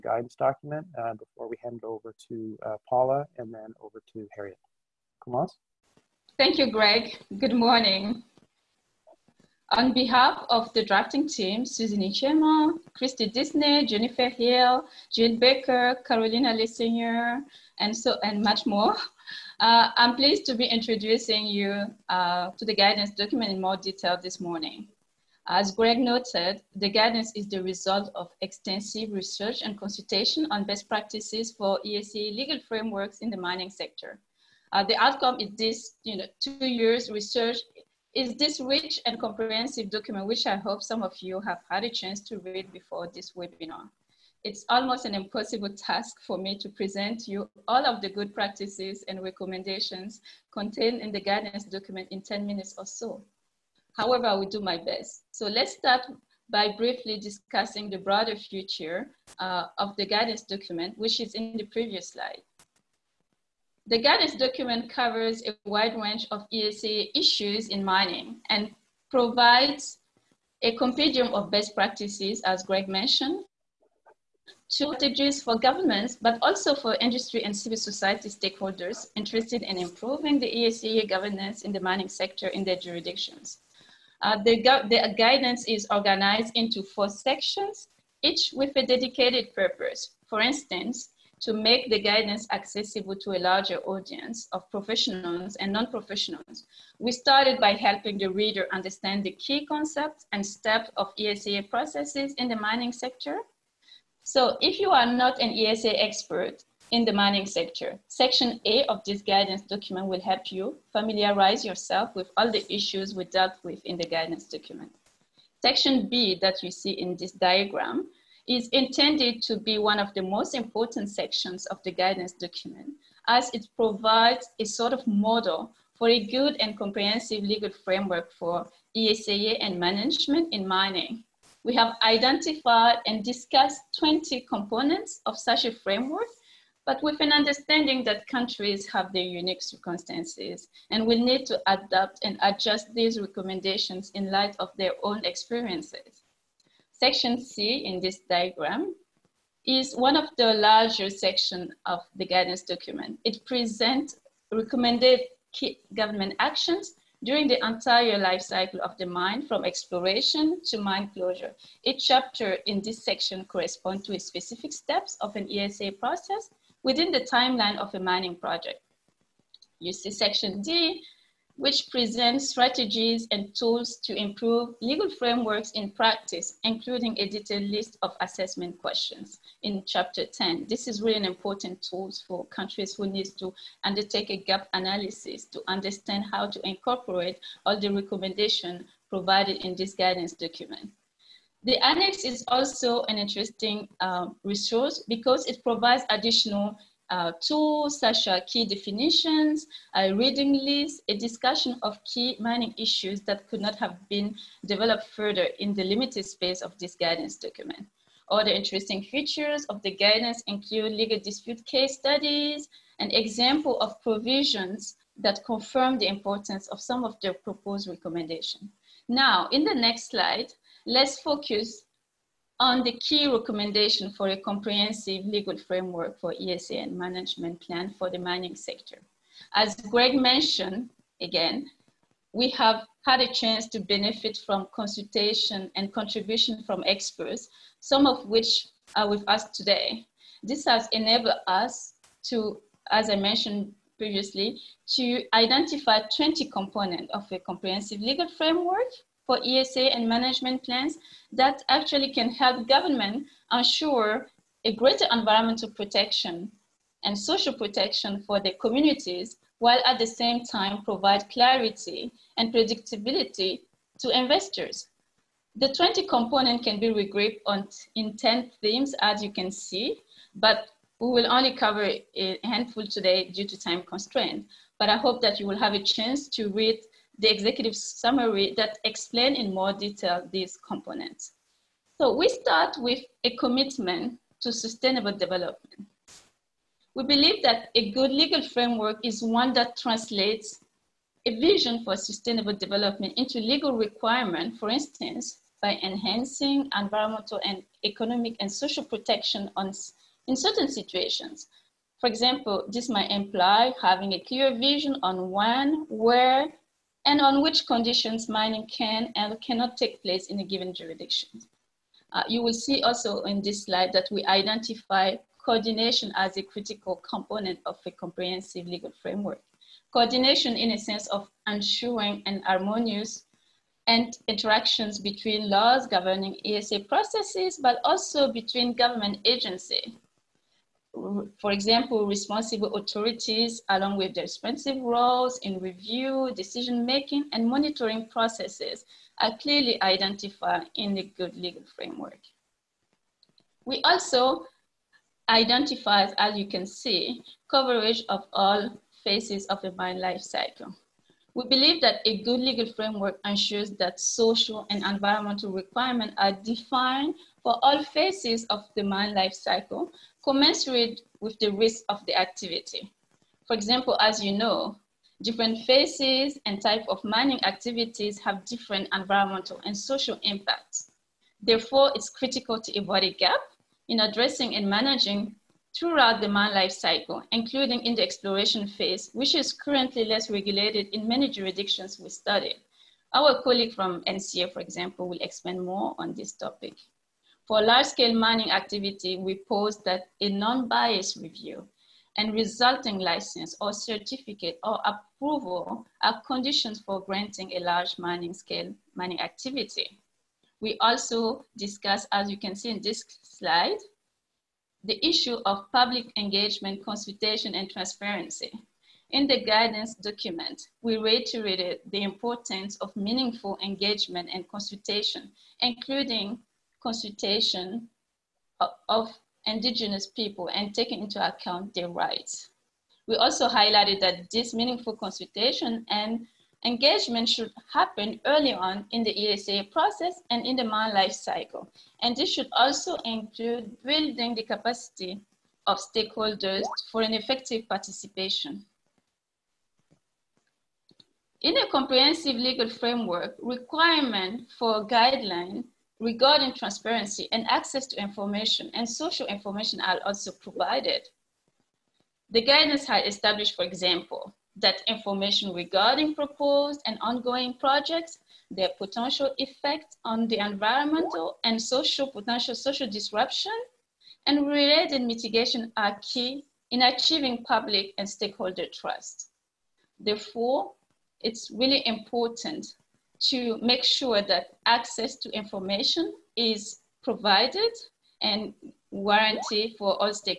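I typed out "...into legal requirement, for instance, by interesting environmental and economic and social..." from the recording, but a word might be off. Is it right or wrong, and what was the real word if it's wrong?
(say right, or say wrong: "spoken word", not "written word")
wrong: "enhancing", not "interesting".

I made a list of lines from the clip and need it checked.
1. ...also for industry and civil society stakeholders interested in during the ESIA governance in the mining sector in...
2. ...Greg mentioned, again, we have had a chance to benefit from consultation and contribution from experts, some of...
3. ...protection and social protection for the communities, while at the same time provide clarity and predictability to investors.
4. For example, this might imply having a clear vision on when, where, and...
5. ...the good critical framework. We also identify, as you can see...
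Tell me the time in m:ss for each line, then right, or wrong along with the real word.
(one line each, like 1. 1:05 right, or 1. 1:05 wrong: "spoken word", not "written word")
1. 1:16 wrong: "improving", not "during"
2. 3:49 right
3. 4:15 right
4. 5:01 right
5. 5:40 wrong: "legal", not "critical".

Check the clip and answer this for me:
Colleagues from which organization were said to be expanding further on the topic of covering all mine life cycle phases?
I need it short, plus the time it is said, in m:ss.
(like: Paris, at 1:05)
NCEA, at 6:24.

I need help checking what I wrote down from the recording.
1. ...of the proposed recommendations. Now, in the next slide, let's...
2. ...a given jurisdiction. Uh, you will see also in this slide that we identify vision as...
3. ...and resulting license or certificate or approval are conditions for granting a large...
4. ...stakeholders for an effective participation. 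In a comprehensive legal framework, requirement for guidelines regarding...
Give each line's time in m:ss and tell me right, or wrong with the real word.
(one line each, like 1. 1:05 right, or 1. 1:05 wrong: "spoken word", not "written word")
1. 3:37 right
2. 5:10 wrong: "coordination", not "vision"
3. 6:32 right
4. 7:15 right.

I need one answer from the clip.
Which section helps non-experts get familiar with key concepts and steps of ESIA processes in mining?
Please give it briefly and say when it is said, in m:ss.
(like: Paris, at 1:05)
Section A, at 1:48.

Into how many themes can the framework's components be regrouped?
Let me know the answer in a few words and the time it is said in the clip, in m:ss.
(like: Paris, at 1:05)
10, at 4:28.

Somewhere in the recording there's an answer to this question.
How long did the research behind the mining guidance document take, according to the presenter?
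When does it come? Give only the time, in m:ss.
0:36.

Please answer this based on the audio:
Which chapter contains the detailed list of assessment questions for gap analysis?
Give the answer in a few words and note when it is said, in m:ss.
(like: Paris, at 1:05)
Chapter 10, at 2:59.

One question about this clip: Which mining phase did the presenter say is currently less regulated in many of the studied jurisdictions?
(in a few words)
exploration phase.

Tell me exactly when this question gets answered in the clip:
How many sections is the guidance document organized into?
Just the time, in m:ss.
1:26.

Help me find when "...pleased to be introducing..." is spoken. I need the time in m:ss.
0:20.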